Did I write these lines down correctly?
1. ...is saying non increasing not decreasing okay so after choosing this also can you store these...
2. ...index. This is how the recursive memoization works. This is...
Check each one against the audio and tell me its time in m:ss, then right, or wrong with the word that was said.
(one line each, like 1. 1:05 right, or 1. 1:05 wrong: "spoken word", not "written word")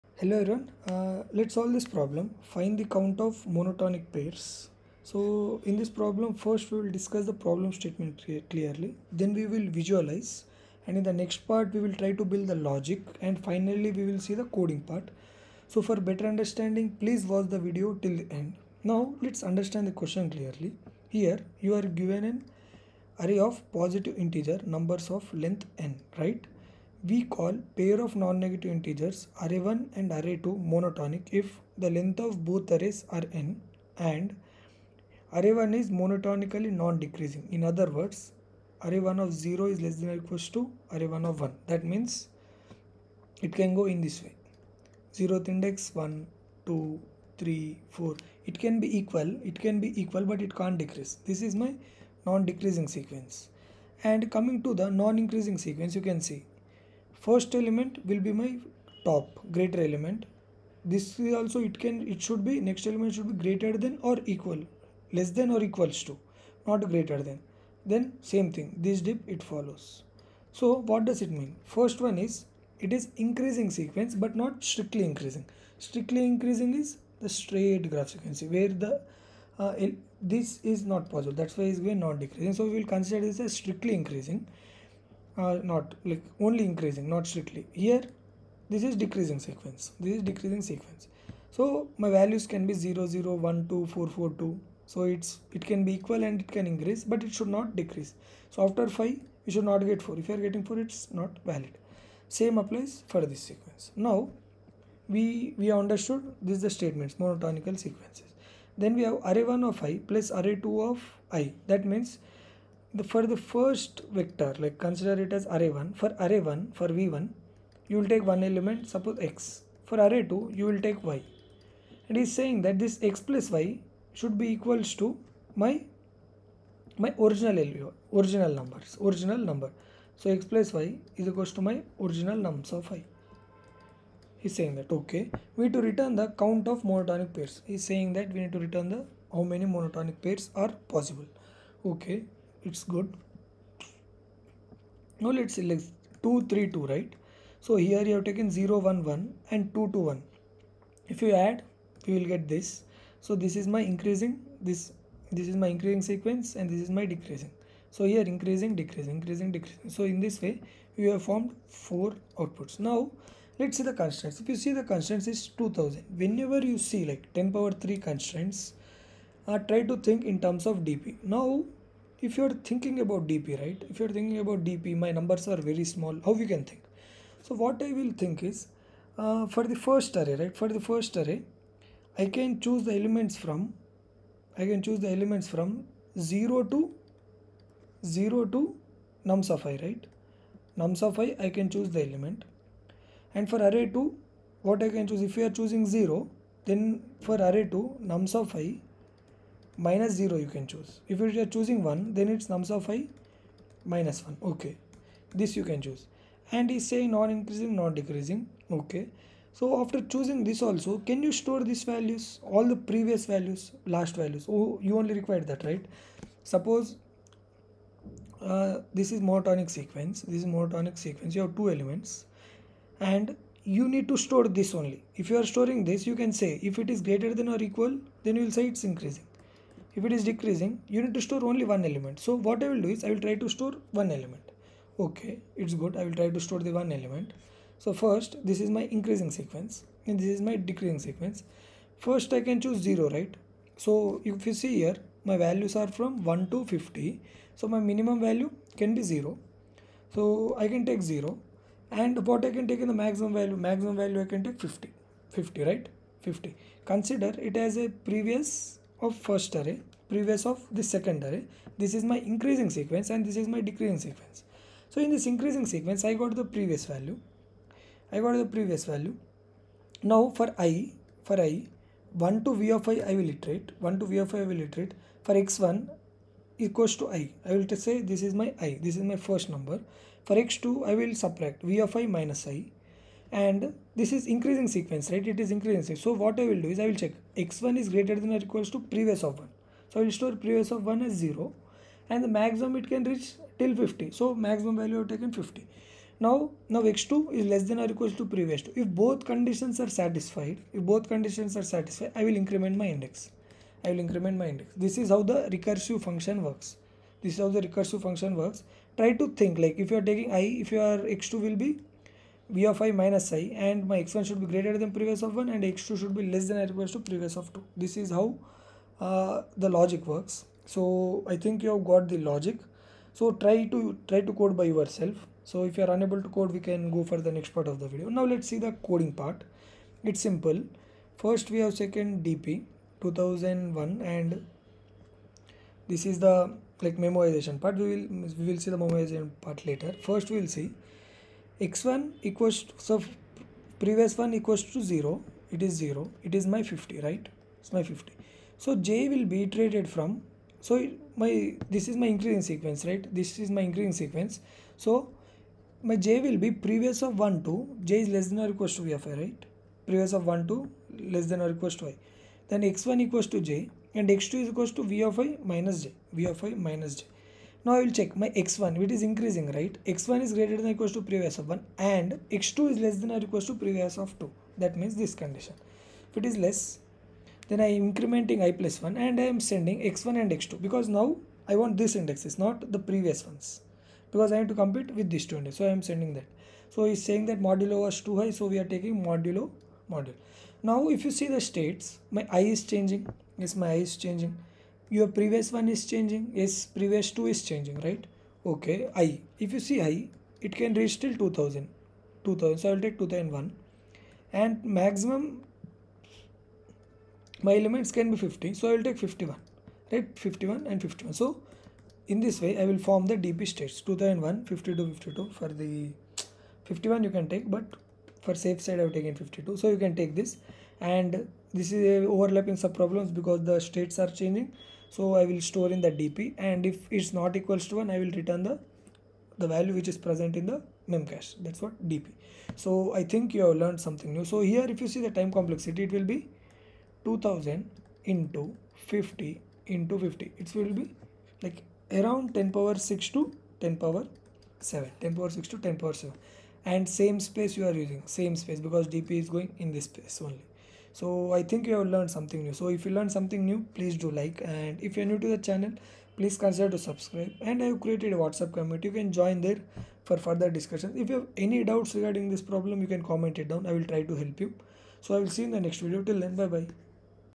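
1. 3:26 right
2. 5:04 wrong: "function", not "memoization".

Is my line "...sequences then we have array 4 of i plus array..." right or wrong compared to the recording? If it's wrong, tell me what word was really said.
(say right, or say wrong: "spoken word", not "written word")
wrong: "1", not "4".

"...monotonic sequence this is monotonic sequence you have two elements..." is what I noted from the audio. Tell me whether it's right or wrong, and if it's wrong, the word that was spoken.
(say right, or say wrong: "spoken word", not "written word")
right.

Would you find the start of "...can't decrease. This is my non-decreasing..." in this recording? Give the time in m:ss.
0:50.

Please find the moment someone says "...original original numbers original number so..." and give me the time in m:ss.
2:07.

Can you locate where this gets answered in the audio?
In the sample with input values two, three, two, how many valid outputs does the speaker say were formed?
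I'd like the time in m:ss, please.
2:41.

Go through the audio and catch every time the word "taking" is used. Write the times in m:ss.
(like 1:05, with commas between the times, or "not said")
5:10, 6:28.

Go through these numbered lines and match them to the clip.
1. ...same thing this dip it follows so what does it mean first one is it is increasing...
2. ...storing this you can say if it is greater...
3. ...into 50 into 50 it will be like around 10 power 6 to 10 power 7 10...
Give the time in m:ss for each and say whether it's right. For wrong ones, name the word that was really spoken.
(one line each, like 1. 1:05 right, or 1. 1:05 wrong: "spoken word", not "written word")
1. 1:08 right
2. 3:45 right
3. 7:18 right.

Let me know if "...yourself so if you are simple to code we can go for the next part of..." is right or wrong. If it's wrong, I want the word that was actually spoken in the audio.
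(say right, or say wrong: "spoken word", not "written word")
wrong: "unable", not "simple".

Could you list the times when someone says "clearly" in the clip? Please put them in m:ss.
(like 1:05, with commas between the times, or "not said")
0:08, 0:20.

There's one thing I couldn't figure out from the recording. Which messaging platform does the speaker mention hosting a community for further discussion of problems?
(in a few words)
WhatsApp.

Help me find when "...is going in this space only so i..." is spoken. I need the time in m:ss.
7:29.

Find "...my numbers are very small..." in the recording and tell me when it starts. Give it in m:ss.
2:55.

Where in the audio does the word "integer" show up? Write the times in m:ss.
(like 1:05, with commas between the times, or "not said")
0:24, 0:28.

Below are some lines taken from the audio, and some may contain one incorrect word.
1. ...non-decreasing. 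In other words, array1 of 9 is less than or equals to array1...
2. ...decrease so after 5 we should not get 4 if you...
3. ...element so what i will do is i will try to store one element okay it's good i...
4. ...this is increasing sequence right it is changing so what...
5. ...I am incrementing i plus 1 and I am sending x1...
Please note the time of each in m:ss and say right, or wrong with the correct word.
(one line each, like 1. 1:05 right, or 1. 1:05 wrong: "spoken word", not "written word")
1. 0:36 wrong: "0", not "9"
2. 1:37 right
3. 3:51 right
4. 4:44 wrong: "increasing", not "changing"
5. 6:17 right.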